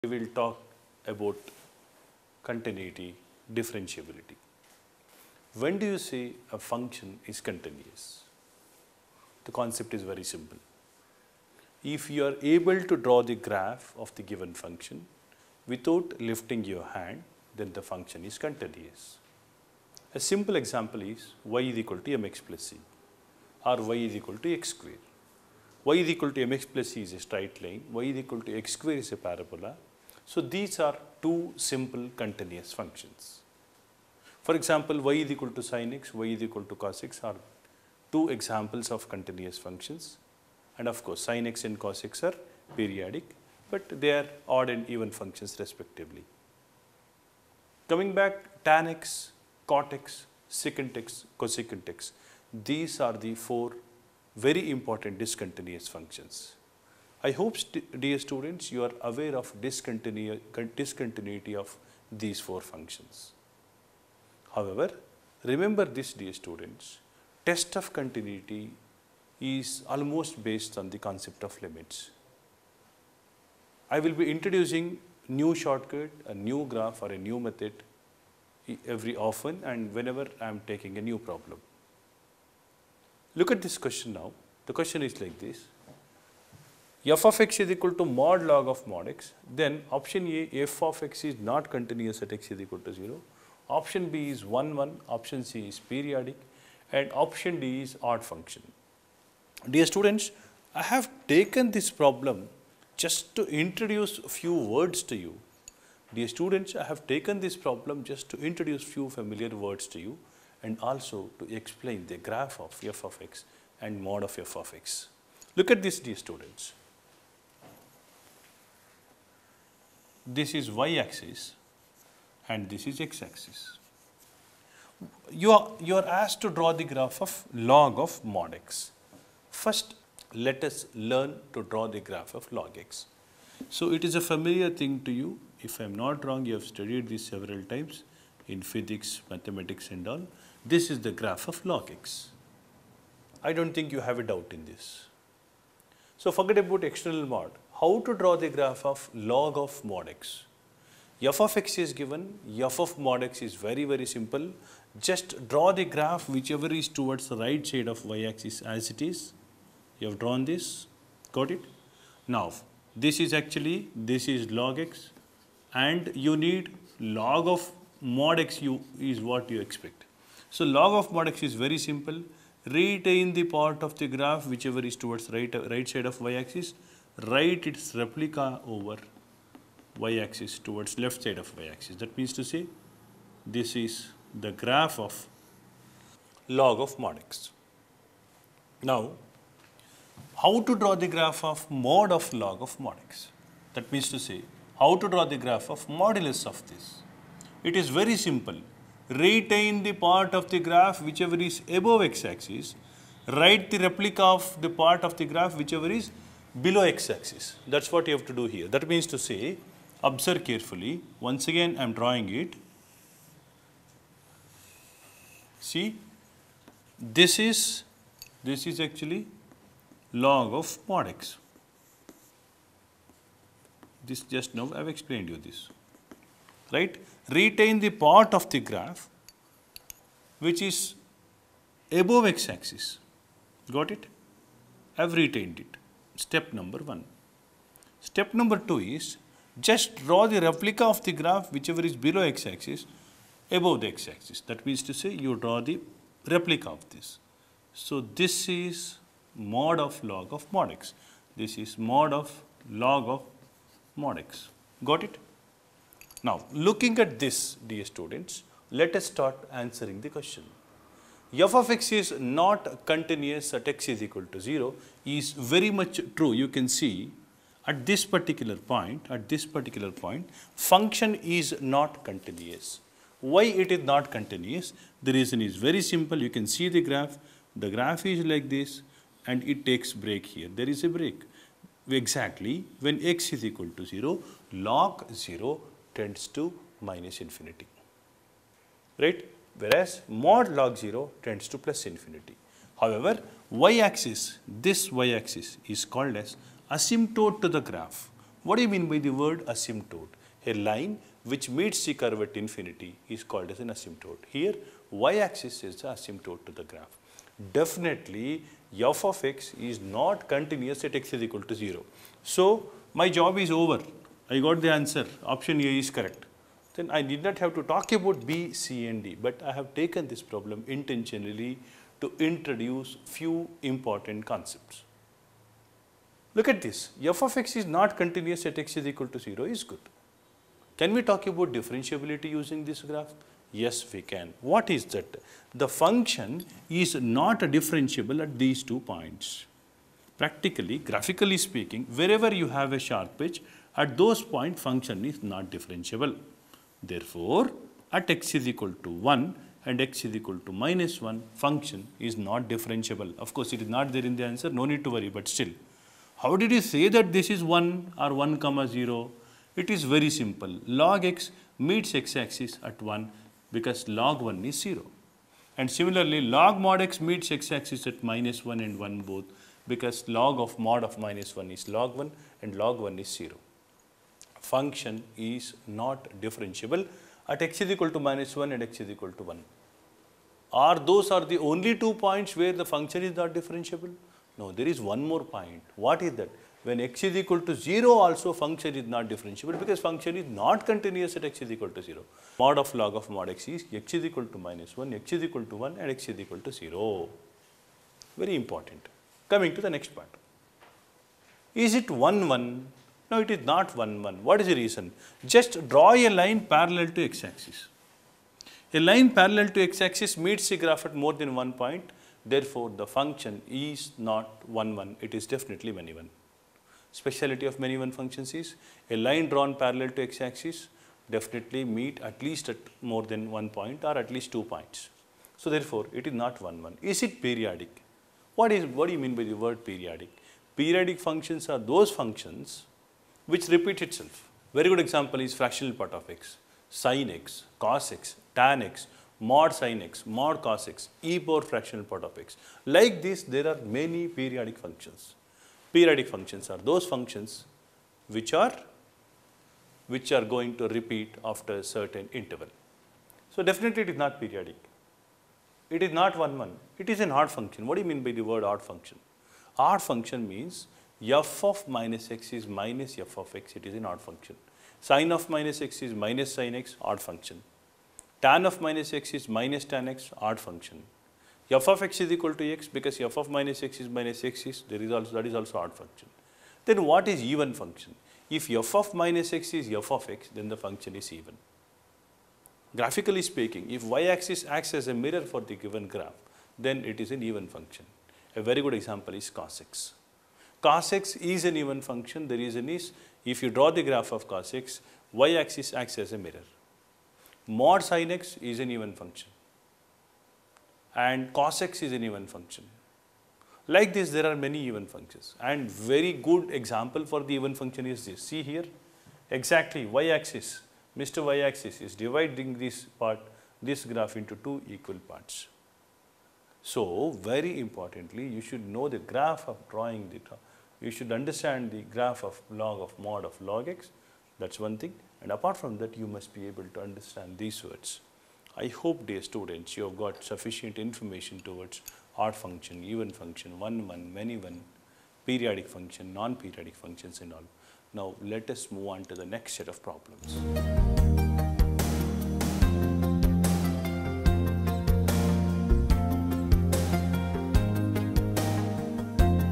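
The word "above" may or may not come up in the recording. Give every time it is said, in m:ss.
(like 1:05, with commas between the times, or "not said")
3:21, 3:51, 4:03.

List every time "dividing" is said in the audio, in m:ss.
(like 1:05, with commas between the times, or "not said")
8:31.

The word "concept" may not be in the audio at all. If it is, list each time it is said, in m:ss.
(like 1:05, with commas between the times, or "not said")
0:09, 1:11, 5:24.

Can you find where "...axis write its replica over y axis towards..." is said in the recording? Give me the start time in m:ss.
2:56.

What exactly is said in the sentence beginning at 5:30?
Can we talk about differentiability using this graph?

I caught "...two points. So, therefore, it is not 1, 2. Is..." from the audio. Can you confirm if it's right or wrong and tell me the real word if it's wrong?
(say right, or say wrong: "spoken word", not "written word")
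wrong: "1", not "2".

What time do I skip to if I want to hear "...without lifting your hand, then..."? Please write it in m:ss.
0:15.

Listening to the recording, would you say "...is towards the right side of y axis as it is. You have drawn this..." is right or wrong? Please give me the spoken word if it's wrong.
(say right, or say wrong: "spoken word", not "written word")
right.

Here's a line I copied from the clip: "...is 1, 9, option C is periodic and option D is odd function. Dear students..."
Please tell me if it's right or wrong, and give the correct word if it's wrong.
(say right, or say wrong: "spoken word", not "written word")
wrong: "1", not "9".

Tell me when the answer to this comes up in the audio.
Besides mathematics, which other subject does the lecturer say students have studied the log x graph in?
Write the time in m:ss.
2:18.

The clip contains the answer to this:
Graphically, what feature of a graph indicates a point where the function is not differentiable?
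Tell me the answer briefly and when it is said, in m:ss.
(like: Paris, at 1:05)
A sharp edge, at 5:42.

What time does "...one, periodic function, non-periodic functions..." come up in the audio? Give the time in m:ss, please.
8:54.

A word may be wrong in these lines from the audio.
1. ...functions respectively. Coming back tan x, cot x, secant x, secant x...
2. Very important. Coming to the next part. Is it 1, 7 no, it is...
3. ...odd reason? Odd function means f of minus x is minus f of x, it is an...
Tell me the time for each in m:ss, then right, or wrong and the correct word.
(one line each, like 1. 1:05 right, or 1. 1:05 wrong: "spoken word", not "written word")
1. 0:45 wrong: "cosecant", not "secant"
2. 6:38 wrong: "1", not "7"
3. 7:38 wrong: "function", not "reason".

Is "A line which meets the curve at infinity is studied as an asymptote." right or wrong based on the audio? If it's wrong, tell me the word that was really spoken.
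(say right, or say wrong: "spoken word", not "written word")
wrong: "called", not "studied".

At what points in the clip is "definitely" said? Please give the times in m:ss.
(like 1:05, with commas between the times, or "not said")
5:07, 6:55, 7:01, 7:33.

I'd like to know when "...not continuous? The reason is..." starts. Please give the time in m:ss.
4:33.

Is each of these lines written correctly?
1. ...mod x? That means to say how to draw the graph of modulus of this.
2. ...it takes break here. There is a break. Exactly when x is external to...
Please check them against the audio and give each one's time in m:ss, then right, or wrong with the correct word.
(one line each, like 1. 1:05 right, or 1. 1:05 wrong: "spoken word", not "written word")
1. 3:12 right
2. 4:39 wrong: "equal", not "external".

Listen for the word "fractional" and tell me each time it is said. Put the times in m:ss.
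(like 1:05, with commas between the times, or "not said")
7:15, 7:21.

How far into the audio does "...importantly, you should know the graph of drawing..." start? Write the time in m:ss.
8:37.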